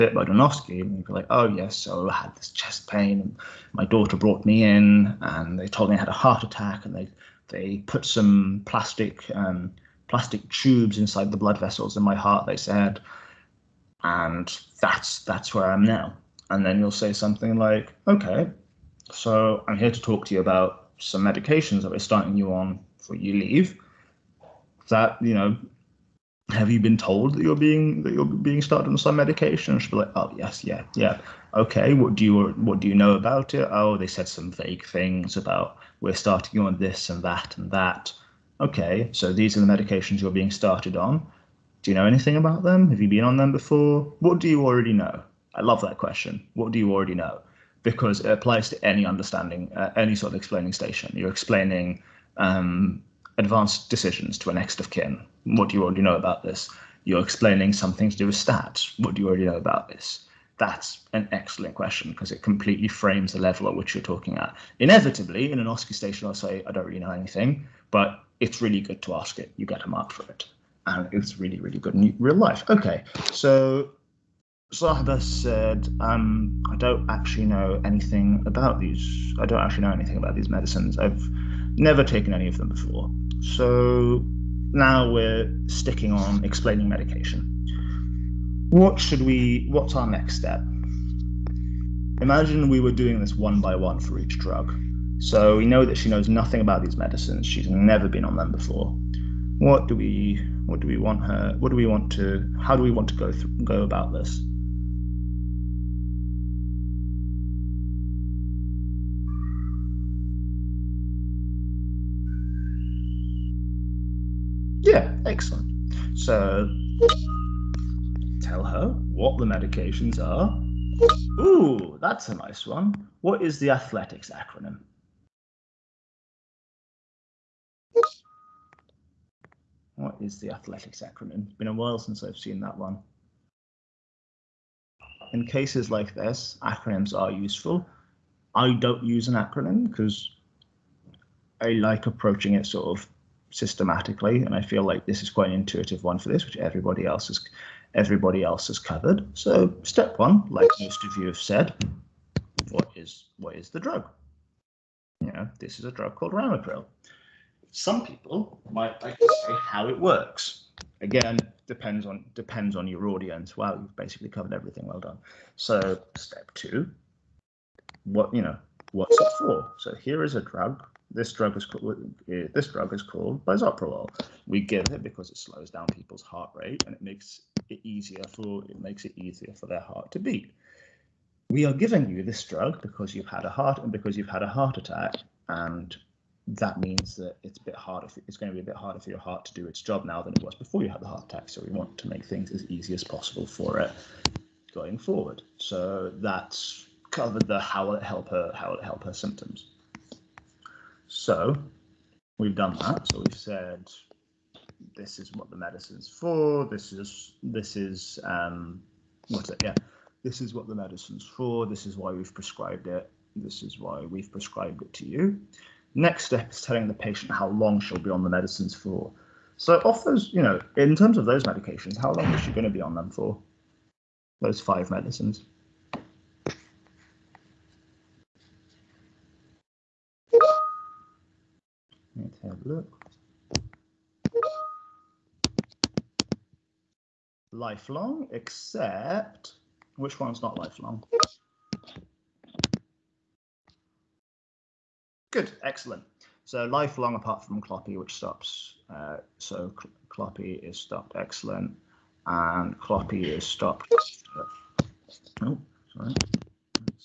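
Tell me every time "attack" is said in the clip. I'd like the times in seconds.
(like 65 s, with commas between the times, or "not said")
6 s, 184 s, 191 s.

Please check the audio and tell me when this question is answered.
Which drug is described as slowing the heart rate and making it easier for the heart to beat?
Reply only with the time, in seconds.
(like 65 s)
173 s.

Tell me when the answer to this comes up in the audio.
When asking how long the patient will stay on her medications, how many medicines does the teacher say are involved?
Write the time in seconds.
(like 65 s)
224 s.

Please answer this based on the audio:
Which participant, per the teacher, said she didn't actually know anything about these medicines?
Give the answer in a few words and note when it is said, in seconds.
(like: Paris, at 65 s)
Sahiba, at 74 s.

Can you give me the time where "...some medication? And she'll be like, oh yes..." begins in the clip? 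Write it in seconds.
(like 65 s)
28 s.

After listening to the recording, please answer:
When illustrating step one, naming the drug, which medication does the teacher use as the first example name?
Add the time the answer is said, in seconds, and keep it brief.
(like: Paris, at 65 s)
Ramipril, at 156 s.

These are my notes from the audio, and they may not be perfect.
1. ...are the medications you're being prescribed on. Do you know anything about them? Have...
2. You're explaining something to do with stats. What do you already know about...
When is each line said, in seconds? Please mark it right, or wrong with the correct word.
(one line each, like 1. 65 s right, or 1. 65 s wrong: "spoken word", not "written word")
1. 39 s wrong: "started", not "prescribed"
2. 57 s right.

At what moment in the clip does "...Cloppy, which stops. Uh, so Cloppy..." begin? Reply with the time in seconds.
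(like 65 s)
247 s.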